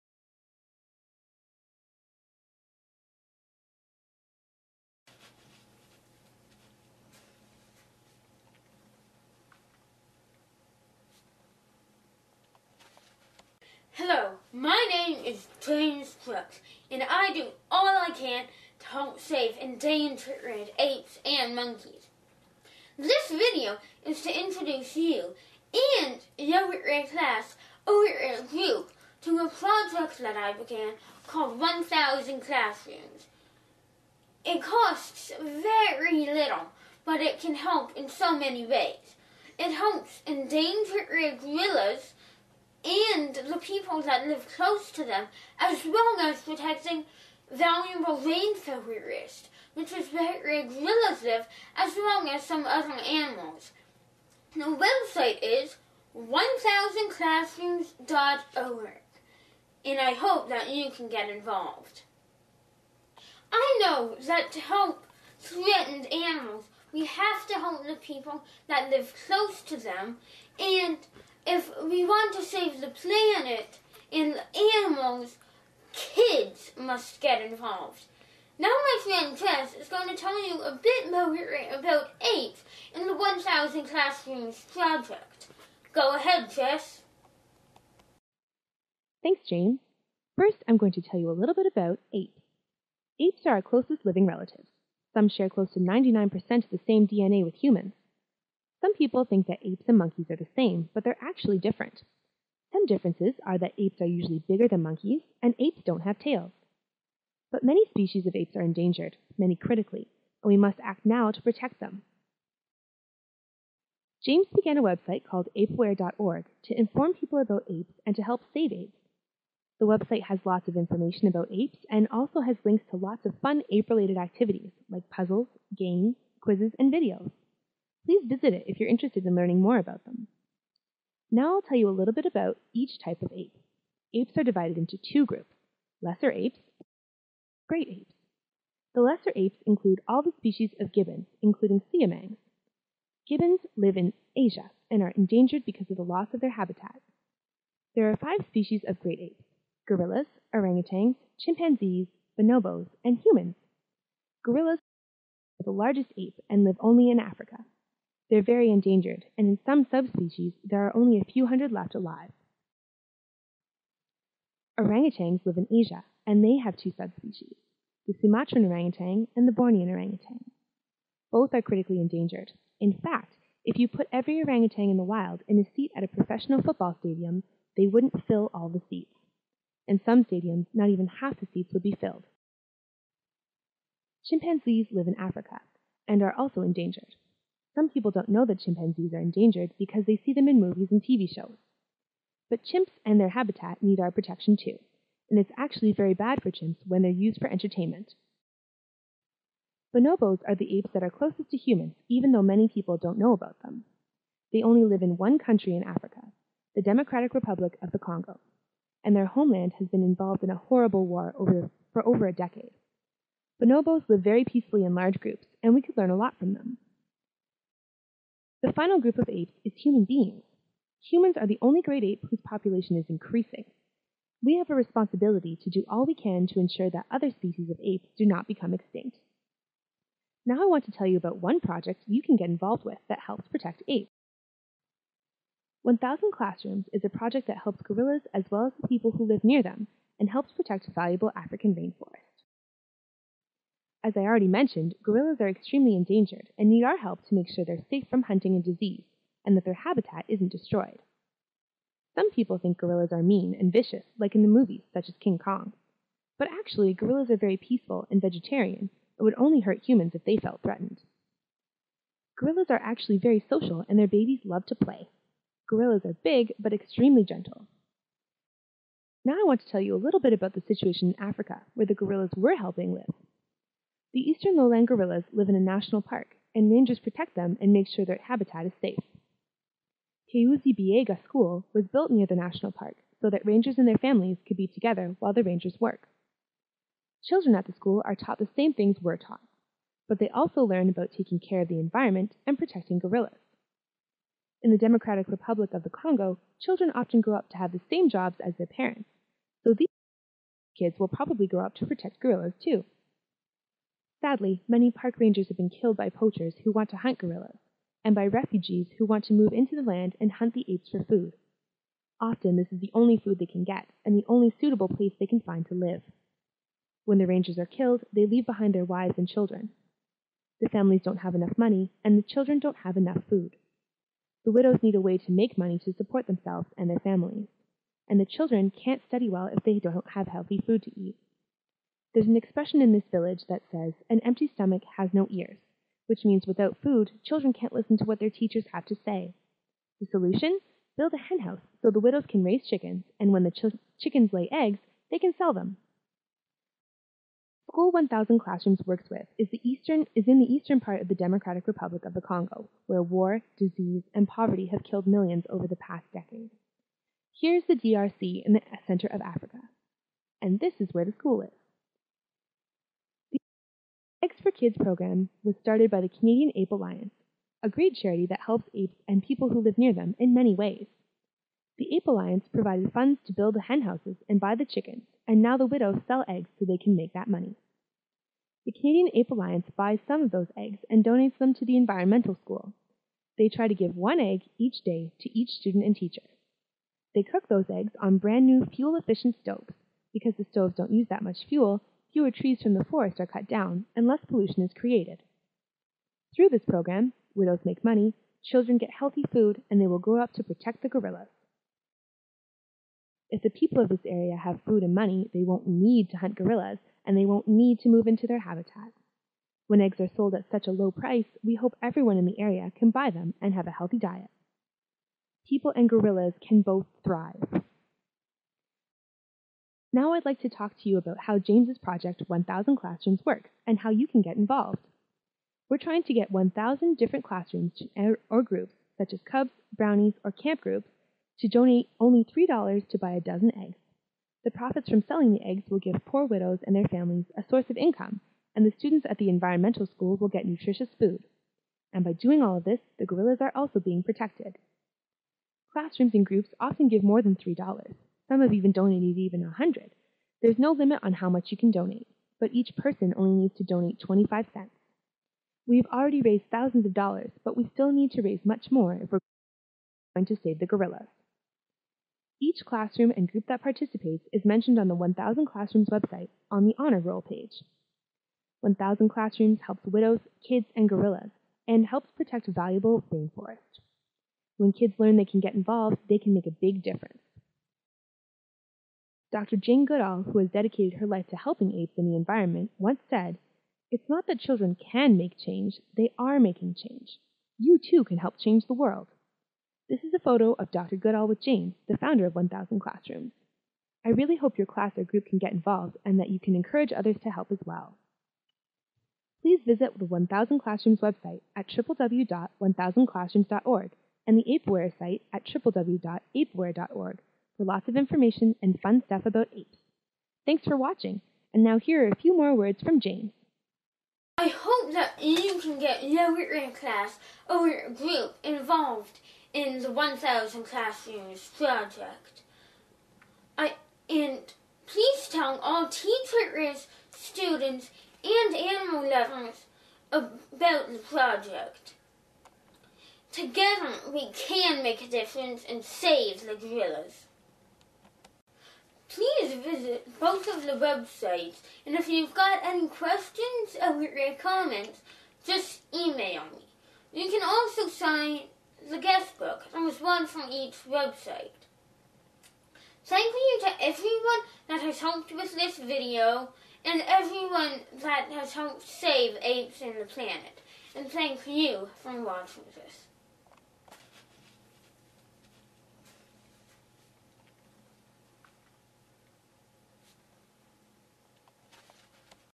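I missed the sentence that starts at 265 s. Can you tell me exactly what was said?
Gorillas are big but extremely gentle.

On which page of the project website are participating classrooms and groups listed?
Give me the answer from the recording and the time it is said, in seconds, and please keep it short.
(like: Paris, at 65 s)
Honor Roll, at 466 s.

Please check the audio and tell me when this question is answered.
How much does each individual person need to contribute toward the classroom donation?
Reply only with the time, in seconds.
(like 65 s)
453 s.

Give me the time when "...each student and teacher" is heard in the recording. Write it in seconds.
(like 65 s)
385 s.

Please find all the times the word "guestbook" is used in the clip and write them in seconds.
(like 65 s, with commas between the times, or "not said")
548 s.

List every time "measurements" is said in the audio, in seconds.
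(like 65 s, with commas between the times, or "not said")
not said.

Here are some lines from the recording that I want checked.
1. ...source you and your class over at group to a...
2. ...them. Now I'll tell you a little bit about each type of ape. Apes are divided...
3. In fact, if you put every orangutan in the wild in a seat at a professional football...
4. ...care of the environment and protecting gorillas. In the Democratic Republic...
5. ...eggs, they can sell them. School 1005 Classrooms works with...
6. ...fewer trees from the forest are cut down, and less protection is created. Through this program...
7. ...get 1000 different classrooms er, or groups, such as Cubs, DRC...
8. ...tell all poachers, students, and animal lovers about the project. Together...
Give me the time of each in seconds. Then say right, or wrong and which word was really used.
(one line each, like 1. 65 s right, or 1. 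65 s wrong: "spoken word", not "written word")
1. 24 s wrong: "introduce", not "source"
2. 130 s right
3. 172 s right
4. 291 s right
5. 344 s wrong: "1000", not "1005"
6. 392 s wrong: "pollution", not "protection"
7. 426 s wrong: "Brownies", not "DRC"
8. 525 s wrong: "teachers", not "poachers".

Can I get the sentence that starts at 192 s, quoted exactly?
But chimps and their habitat need our protection too, and it's actually very bad for chimps when they're used for entertainment.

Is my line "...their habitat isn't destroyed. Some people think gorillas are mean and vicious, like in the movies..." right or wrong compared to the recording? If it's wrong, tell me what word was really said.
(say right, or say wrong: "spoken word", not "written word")
right.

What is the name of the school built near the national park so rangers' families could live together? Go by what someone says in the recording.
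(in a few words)
Kahuzi School.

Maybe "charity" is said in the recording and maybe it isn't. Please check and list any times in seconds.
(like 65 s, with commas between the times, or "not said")
367 s.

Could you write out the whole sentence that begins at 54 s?
The website is 1000classrooms.org, and I hope that you can get involved.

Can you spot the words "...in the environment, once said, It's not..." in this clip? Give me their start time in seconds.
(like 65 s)
481 s.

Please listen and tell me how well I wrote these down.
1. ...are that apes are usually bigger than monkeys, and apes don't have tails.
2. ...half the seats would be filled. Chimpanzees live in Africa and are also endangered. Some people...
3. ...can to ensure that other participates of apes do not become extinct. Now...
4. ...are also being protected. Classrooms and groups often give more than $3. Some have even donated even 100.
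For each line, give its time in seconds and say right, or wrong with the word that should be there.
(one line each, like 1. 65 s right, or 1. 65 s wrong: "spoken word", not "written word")
1. 103 s right
2. 181 s right
3. 226 s wrong: "species", not "participates"
4. 443 s right.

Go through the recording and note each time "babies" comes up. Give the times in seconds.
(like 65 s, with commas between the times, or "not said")
264 s.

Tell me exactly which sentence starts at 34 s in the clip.
It costs very little, but it can help in so many ways.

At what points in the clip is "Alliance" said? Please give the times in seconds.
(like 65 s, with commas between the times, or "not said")
366 s, 372 s, 379 s.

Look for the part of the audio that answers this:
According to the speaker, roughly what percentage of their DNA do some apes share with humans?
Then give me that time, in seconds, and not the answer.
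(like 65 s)
95 s.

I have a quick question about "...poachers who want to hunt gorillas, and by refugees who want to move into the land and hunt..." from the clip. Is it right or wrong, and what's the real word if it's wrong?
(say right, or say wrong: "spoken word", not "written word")
right.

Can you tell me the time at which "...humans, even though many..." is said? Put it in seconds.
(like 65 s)
201 s.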